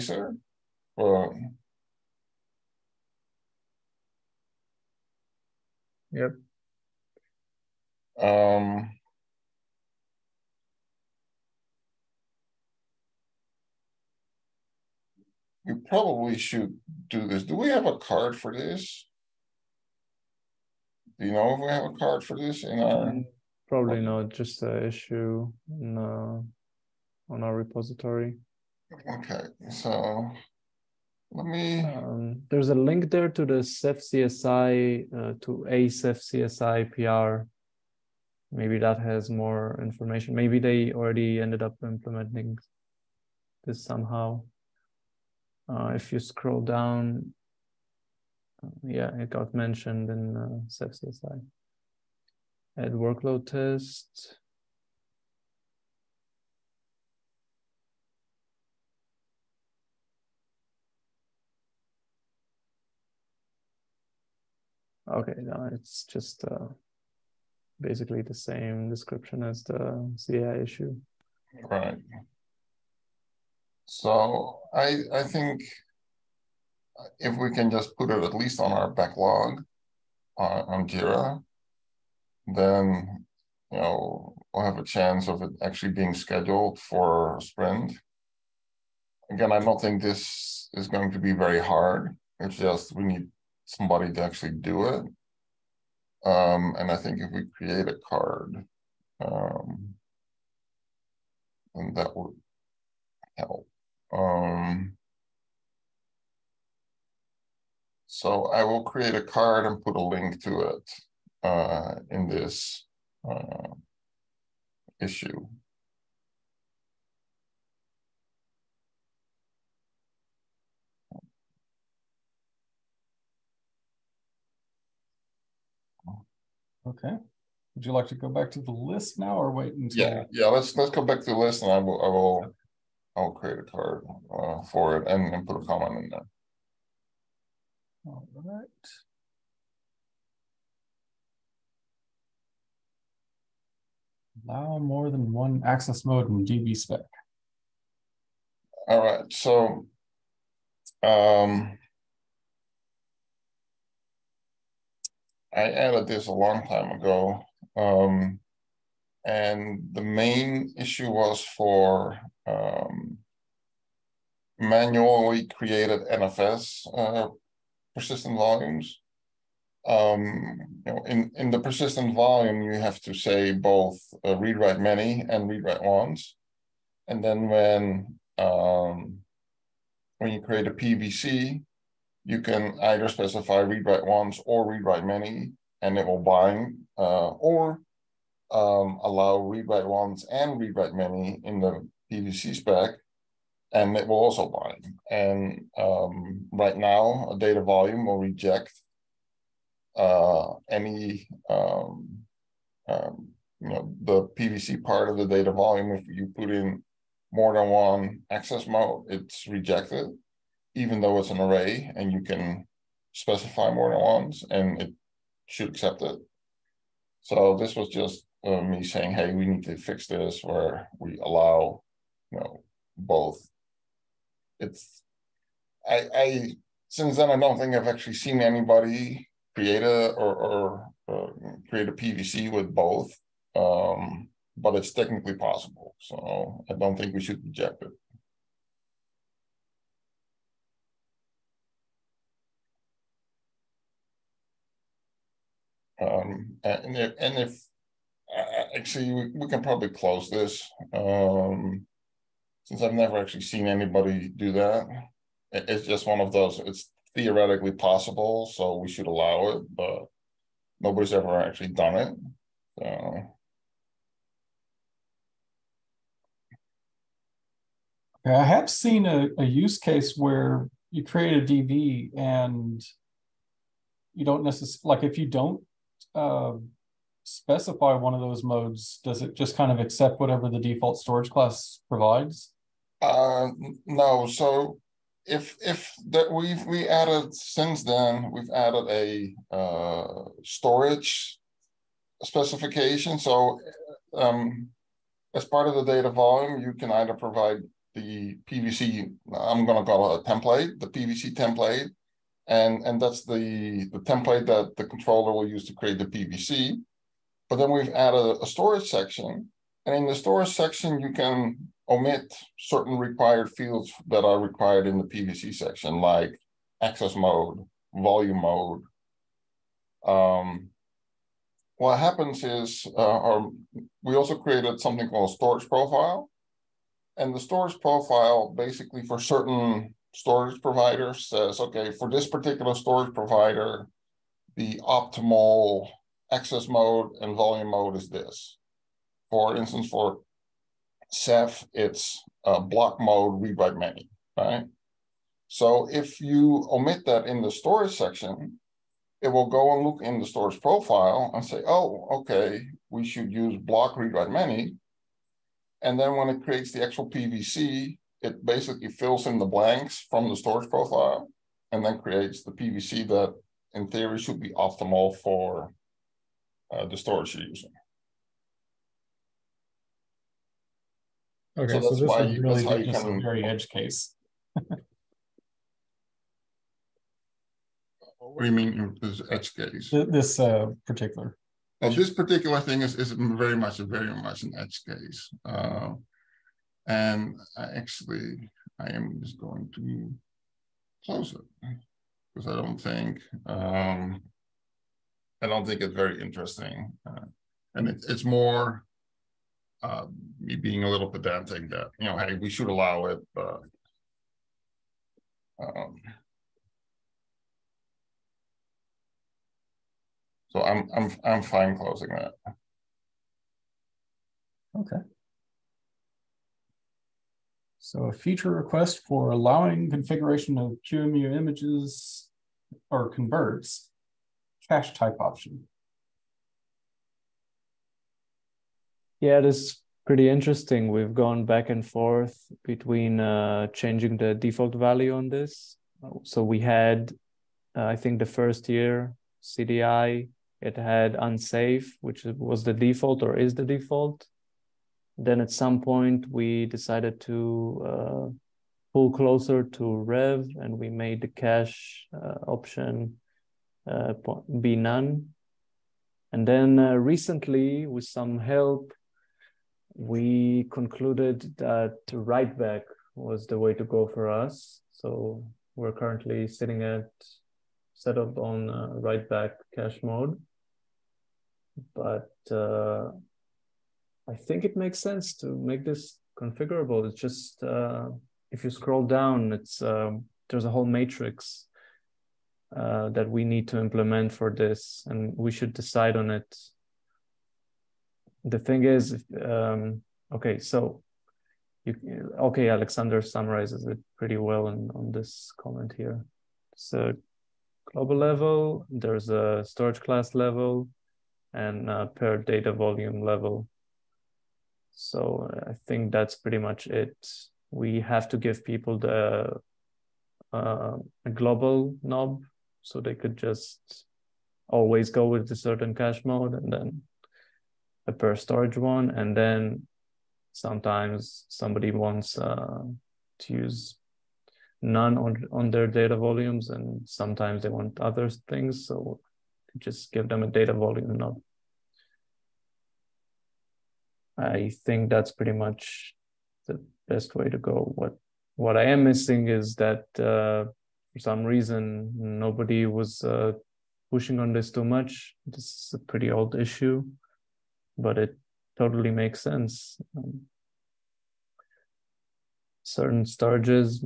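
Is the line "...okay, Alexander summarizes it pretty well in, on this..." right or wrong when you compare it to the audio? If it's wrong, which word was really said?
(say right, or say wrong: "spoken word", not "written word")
right.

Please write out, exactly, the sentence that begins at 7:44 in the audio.
So we're currently sitting at set up on uh, right back cash mode.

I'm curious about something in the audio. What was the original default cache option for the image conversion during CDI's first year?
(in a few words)
unsafe.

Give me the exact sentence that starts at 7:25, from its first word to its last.
Then at some point, we decided to uh, pull closer to Rev and we made the cache uh, option uh, be none.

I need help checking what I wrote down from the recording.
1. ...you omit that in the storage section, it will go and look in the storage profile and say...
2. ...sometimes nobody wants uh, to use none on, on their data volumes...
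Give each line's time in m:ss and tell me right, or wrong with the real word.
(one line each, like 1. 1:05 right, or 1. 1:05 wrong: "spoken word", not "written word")
1. 5:46 right
2. 8:40 wrong: "somebody", not "nobody".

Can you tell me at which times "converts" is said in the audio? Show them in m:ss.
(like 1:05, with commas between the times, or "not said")
7:03.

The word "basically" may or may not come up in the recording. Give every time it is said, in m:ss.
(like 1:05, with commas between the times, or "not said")
1:07, 5:28, 5:58.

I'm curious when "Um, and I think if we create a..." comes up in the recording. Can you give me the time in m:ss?
1:36.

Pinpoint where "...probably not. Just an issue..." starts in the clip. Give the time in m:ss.
0:23.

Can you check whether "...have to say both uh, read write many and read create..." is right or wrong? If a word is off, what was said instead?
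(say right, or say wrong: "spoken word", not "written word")
wrong: "write", not "create".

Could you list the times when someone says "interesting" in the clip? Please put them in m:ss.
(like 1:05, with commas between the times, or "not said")
6:36, 7:10.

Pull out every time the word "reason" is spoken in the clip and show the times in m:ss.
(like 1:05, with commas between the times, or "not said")
9:01.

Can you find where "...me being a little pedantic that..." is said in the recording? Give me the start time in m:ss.
6:40.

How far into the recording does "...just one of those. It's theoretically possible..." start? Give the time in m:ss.
4:15.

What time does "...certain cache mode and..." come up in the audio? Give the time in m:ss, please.
8:35.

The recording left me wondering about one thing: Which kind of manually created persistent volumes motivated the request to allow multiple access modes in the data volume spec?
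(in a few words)
NFS.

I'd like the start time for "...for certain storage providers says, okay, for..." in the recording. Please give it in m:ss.
5:29.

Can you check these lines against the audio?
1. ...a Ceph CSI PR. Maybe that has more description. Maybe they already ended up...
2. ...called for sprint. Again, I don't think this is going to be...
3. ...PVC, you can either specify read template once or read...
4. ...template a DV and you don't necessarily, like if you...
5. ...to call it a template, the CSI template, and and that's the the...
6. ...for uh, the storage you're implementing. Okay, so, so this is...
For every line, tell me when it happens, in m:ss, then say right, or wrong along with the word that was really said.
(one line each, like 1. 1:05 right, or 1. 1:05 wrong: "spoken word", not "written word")
1. 0:35 wrong: "information", not "description"
2. 1:26 wrong: "scheduled", not "called"
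3. 3:00 wrong: "write", not "template"
4. 4:31 wrong: "create", not "template"
5. 4:59 wrong: "PVC", not "CSI"
6. 6:05 wrong: "using", not "implementing".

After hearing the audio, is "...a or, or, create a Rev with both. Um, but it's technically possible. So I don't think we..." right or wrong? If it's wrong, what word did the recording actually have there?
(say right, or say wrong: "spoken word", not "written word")
wrong: "PVC", not "Rev".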